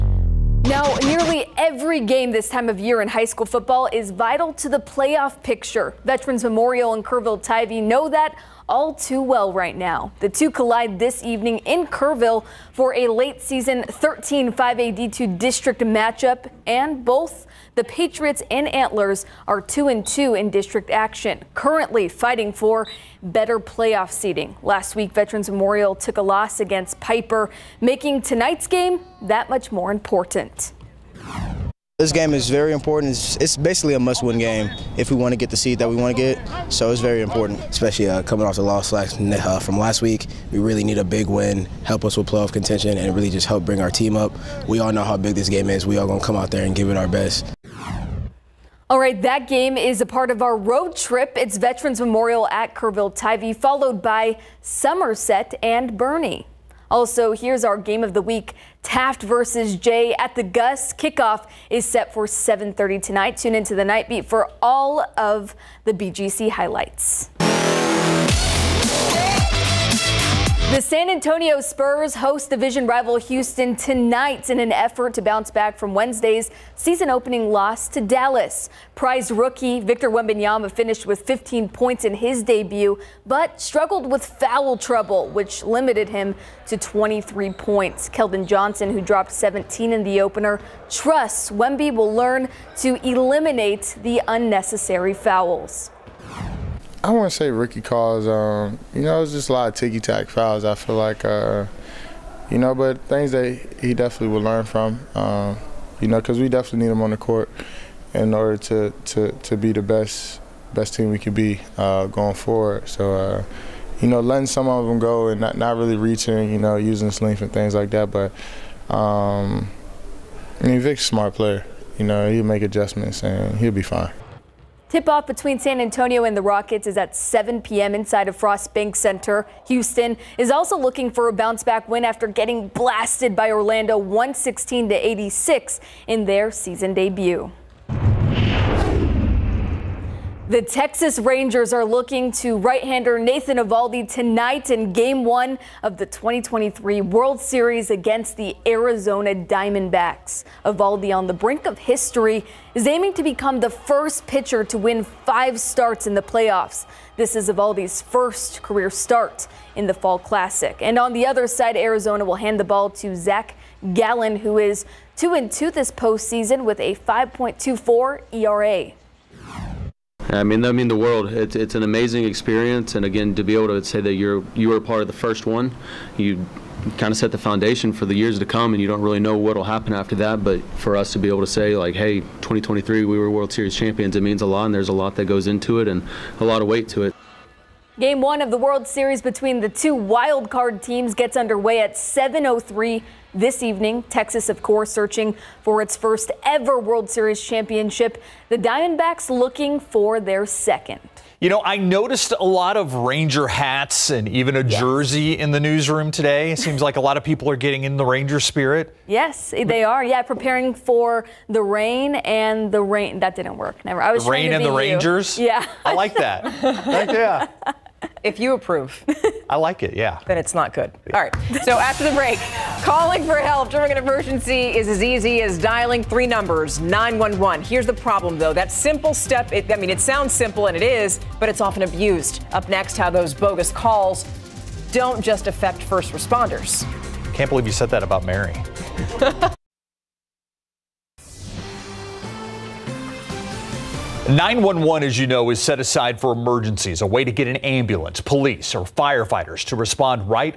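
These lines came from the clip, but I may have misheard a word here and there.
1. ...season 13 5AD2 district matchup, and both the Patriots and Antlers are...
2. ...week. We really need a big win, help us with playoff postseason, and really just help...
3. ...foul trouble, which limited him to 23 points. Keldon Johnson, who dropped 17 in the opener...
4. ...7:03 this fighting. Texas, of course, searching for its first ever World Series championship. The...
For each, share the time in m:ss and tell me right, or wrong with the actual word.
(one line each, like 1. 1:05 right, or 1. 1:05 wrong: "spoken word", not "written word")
1. 0:13 right
2. 0:40 wrong: "contention", not "postseason"
3. 1:24 right
4. 3:11 wrong: "evening", not "fighting".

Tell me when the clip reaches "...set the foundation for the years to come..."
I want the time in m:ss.
2:57.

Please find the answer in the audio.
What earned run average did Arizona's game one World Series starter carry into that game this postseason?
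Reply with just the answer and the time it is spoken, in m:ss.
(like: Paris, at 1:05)
5.24, at 2:46.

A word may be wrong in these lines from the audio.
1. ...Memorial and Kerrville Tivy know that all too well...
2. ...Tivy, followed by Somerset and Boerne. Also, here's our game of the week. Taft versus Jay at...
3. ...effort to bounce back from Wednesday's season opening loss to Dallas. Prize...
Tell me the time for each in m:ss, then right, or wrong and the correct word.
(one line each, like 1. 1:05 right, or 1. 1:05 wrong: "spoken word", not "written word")
1. 0:06 right
2. 0:53 right
3. 1:14 right.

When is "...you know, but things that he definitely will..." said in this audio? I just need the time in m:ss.
1:42.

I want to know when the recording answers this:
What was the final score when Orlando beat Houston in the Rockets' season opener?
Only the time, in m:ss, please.
2:13.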